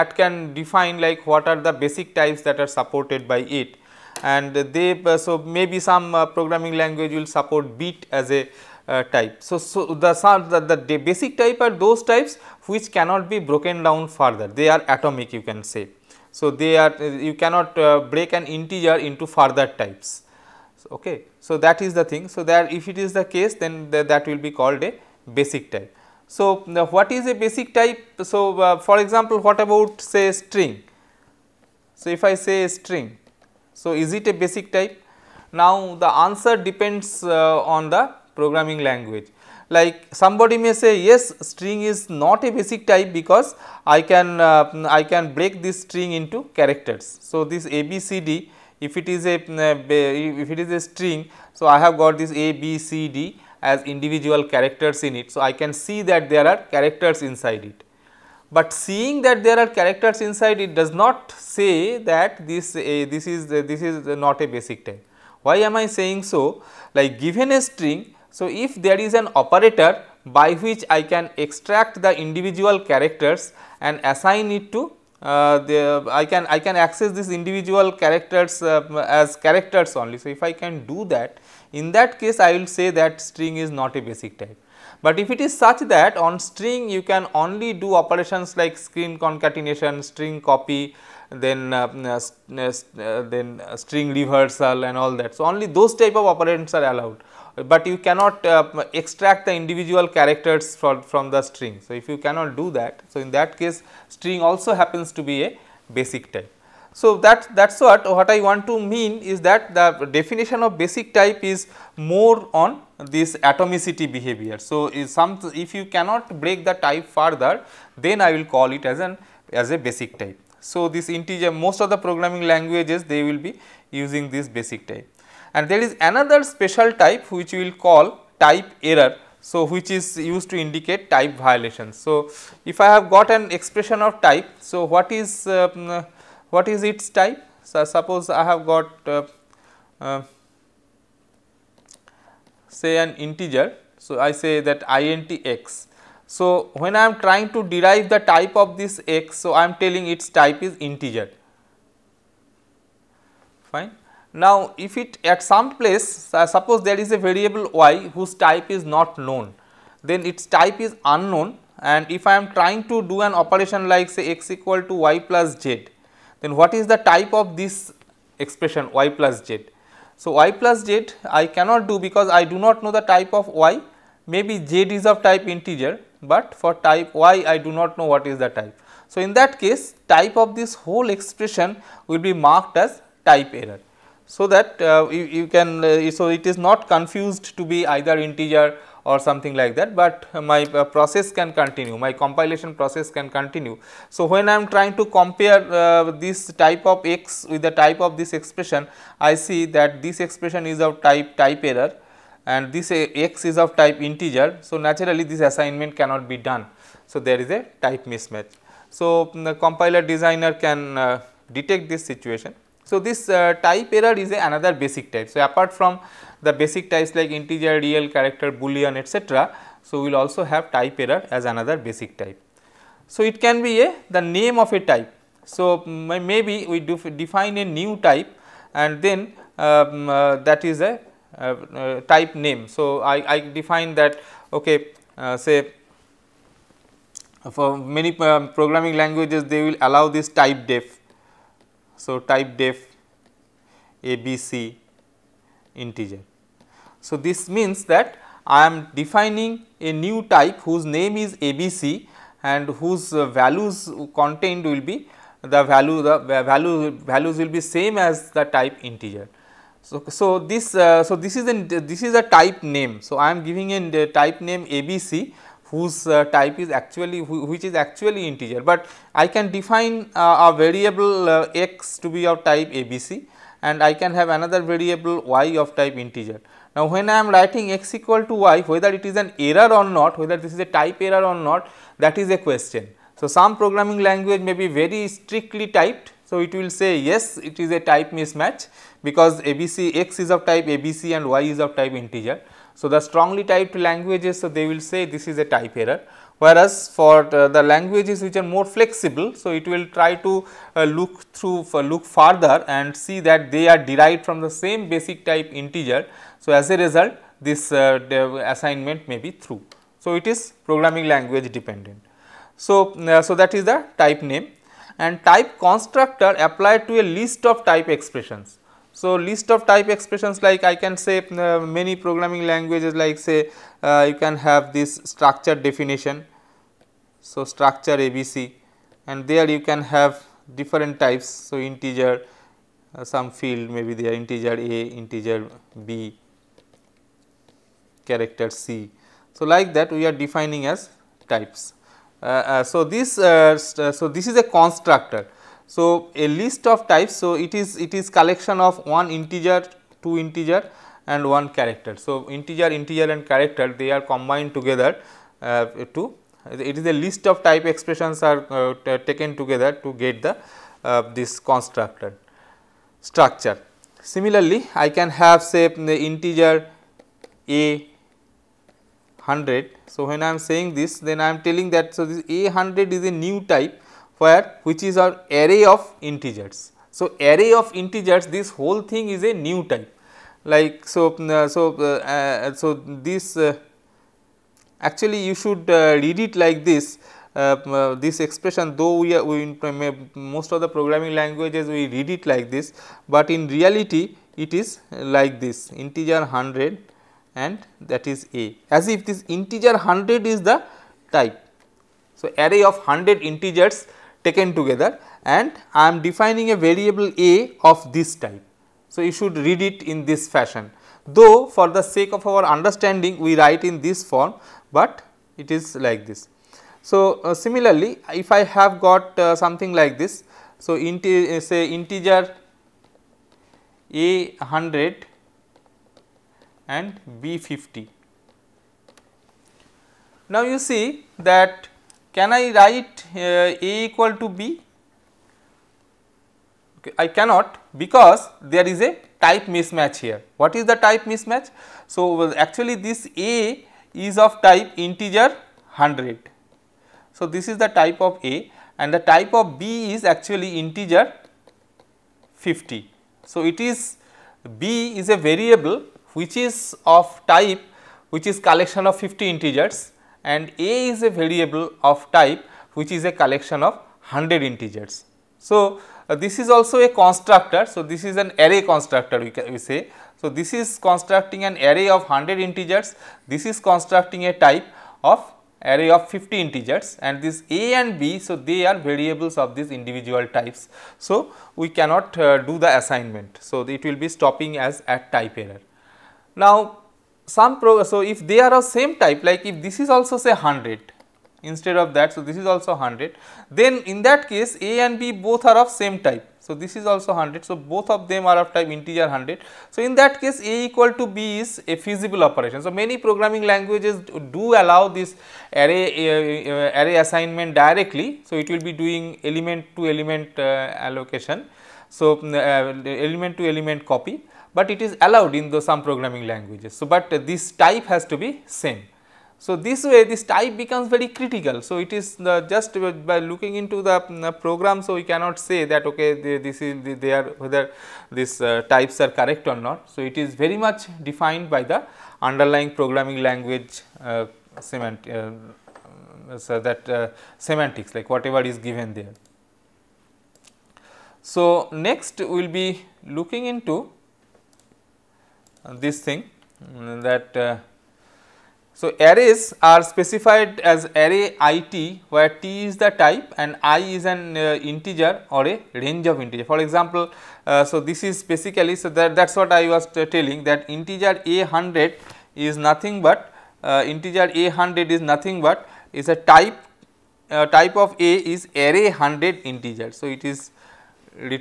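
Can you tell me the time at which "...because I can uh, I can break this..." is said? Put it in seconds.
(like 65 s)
43 s.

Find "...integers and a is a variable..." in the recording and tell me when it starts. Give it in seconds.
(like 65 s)
459 s.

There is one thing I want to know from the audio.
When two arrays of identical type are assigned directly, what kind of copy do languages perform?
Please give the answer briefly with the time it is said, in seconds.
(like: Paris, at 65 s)
element to element copy, at 513 s.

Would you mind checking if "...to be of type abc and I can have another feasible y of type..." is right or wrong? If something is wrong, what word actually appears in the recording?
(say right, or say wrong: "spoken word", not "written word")
wrong: "variable", not "feasible".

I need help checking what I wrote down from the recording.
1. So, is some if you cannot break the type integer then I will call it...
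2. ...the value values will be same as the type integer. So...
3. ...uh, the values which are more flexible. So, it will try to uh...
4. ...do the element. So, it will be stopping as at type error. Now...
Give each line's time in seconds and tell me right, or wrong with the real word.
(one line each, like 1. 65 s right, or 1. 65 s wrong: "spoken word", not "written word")
1. 114 s wrong: "further", not "integer"
2. 256 s right
3. 297 s wrong: "languages", not "values"
4. 482 s wrong: "assignment", not "element".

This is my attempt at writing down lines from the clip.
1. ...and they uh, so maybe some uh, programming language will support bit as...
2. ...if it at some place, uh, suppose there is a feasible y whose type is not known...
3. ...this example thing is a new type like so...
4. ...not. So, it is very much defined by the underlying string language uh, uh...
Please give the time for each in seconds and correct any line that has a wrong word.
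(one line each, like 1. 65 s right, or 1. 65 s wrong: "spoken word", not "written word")
1. 4 s right
2. 154 s wrong: "variable", not "feasible"
3. 378 s wrong: "whole", not "example"
4. 529 s wrong: "programming", not "string".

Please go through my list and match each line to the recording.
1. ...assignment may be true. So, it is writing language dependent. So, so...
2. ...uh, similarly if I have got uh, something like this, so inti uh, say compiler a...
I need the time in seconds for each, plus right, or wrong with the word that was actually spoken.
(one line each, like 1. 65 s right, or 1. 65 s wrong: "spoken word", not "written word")
1. 308 s wrong: "programming", not "writing"
2. 417 s wrong: "integer", not "compiler".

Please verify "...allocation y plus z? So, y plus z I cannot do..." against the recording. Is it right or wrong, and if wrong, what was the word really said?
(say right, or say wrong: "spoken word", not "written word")
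wrong: "expression", not "allocation".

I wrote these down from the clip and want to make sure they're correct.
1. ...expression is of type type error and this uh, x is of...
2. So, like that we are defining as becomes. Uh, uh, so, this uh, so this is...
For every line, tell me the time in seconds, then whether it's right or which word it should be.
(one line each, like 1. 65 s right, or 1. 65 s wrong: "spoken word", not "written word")
1. 200 s right
2. 339 s wrong: "types", not "becomes".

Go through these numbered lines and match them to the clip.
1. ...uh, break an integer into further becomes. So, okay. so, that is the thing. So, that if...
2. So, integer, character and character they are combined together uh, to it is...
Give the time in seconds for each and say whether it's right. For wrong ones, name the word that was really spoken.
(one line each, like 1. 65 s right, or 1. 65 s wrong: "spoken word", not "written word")
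1. 17 s wrong: "types", not "becomes"
2. 351 s wrong: "integer", not "character".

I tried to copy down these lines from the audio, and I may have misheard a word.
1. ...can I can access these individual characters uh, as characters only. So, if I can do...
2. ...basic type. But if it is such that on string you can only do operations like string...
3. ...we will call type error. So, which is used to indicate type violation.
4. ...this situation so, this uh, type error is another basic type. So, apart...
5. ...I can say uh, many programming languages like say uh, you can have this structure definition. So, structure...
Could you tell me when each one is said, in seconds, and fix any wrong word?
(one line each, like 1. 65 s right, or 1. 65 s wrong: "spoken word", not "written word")
1. 76 s right
2. 84 s right
3. 127 s right
4. 211 s right
5. 320 s right.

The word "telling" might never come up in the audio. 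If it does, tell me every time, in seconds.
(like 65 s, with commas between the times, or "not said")
149 s, 371 s, 560 s.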